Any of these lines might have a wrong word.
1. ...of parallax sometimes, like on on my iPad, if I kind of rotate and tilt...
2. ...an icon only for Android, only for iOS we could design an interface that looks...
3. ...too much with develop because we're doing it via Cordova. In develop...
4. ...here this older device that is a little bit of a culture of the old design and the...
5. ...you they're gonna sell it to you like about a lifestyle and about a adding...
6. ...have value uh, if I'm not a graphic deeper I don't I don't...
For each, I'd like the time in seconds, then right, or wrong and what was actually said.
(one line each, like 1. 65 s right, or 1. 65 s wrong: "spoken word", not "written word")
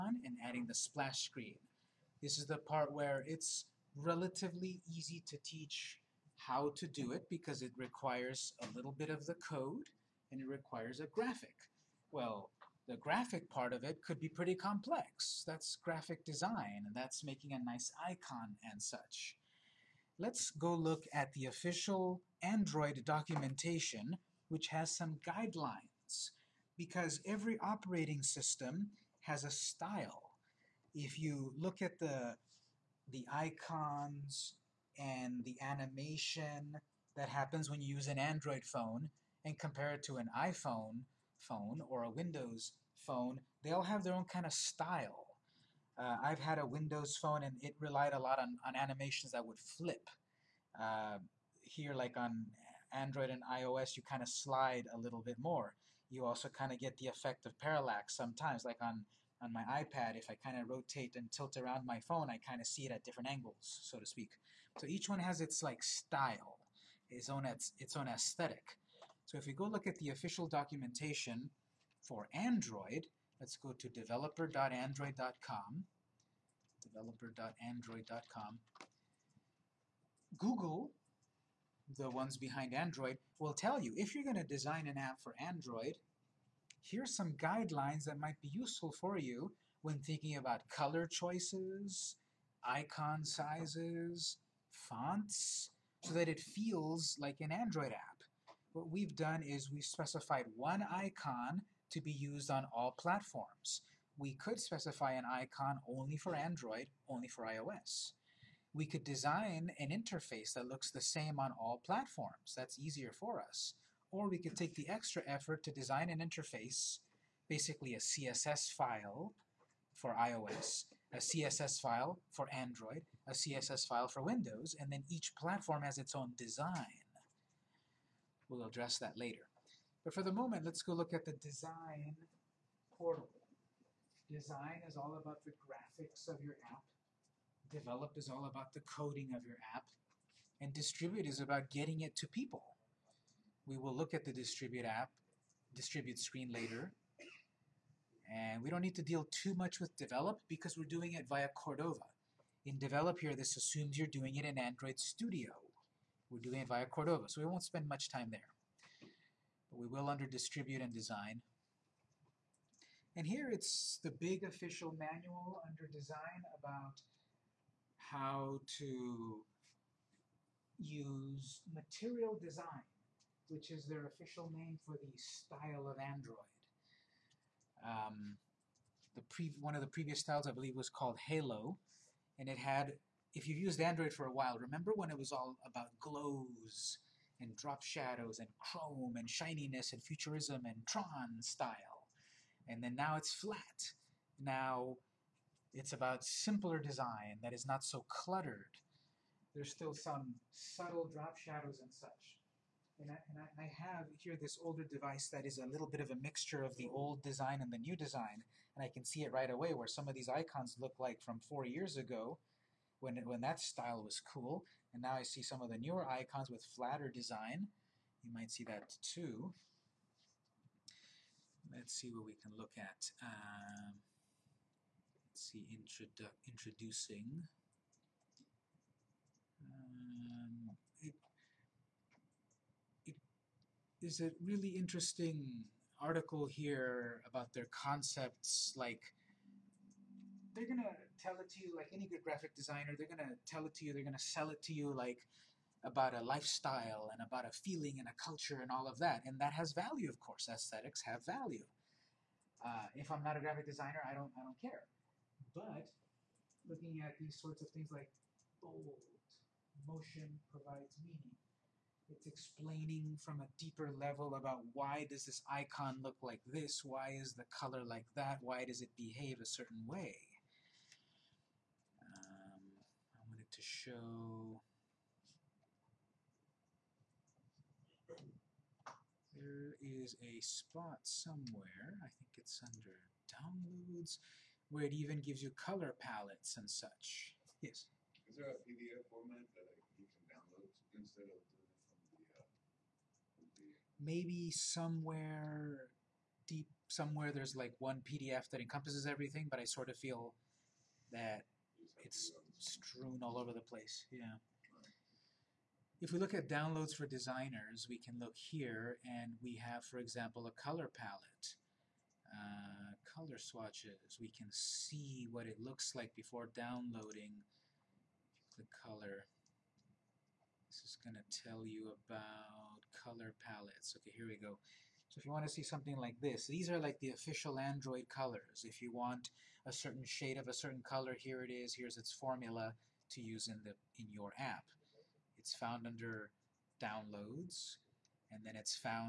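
1. 57 s right
2. 105 s right
3. 149 s right
4. 204 s wrong: "mixture", not "culture"
5. 243 s wrong: "feeling", not "adding"
6. 251 s wrong: "designer", not "deeper".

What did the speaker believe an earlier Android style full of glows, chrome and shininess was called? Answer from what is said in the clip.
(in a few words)
Halo.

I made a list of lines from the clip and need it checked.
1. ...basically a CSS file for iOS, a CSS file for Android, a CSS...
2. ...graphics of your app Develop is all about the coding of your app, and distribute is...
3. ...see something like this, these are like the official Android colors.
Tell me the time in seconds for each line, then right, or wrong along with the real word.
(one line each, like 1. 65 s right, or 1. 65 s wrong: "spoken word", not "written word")
1. 117 s right
2. 135 s right
3. 325 s right.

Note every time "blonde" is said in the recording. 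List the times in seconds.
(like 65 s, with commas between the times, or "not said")
not said.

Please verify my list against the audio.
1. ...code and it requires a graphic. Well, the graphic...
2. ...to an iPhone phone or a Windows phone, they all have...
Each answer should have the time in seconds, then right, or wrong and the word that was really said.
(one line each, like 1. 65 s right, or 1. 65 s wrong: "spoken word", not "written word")
1. 9 s right
2. 40 s right.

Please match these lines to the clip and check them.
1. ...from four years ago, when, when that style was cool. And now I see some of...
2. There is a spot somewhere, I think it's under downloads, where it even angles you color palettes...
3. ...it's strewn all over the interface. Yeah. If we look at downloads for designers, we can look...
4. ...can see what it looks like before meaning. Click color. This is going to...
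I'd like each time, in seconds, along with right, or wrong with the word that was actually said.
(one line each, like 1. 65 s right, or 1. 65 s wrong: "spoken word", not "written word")
1. 211 s right
2. 279 s wrong: "gives", not "angles"
3. 301 s wrong: "place", not "interface"
4. 314 s wrong: "downloading", not "meaning".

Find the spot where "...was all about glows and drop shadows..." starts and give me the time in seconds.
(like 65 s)
185 s.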